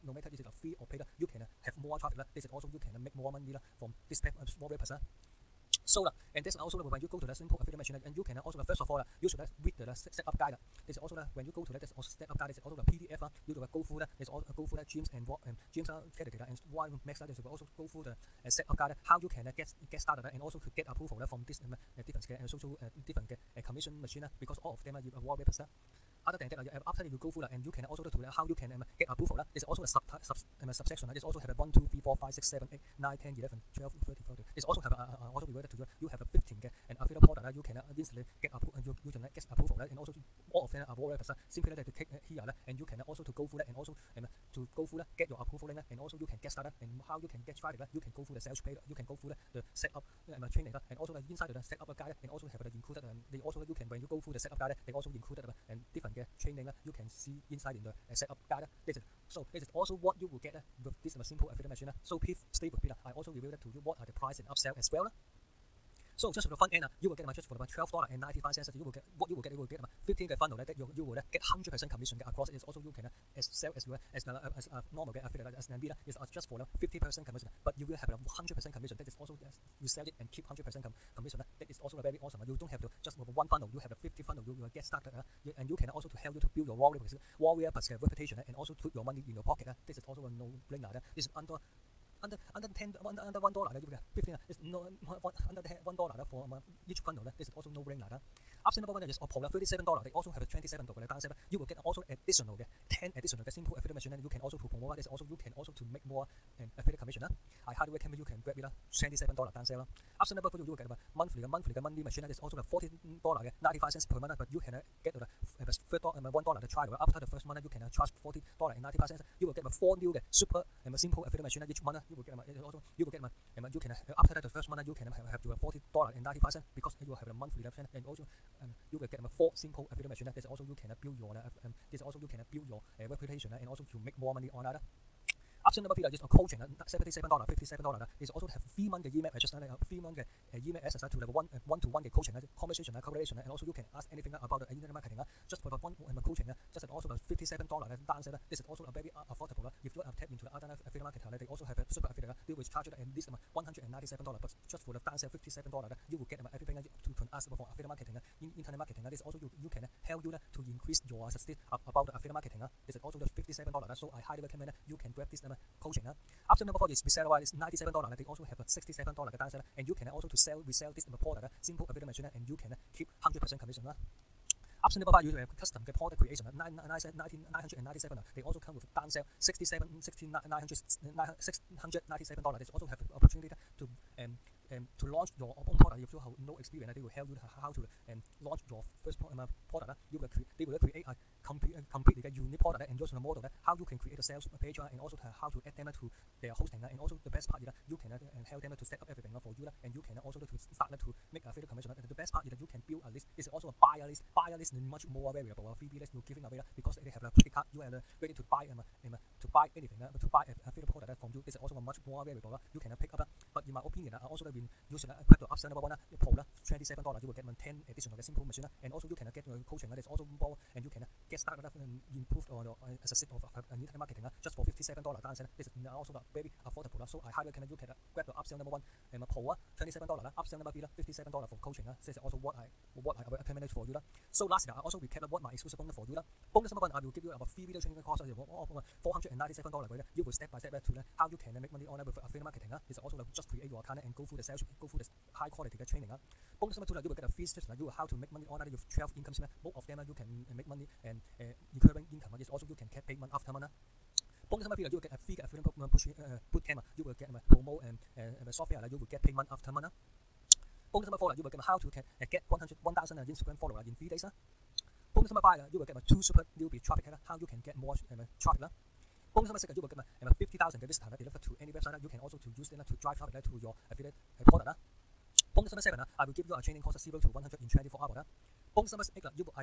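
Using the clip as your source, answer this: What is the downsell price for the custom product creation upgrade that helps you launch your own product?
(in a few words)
$697.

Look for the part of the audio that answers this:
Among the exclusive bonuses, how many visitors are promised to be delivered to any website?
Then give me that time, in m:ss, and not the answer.
4:30.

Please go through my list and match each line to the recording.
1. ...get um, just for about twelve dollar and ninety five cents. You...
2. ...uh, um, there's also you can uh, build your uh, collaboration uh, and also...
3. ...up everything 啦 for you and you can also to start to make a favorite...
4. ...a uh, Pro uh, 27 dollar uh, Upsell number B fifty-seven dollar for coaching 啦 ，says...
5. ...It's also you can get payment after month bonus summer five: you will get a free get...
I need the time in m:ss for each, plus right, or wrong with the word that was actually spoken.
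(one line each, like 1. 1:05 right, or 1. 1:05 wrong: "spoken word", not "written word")
1. 1:07 right
2. 2:11 wrong: "reputation", not "collaboration"
3. 3:19 right
4. 3:49 right
5. 4:12 wrong: "three", not "five".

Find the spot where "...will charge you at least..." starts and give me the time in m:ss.
2:32.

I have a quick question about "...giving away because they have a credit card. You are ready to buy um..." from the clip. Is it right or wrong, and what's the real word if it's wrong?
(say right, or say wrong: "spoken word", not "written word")
right.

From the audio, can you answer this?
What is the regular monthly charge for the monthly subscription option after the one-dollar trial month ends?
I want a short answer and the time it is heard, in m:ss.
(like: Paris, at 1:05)
$40.95, at 1:58.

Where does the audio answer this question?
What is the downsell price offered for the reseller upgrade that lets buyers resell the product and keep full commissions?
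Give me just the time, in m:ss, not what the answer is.
2:48.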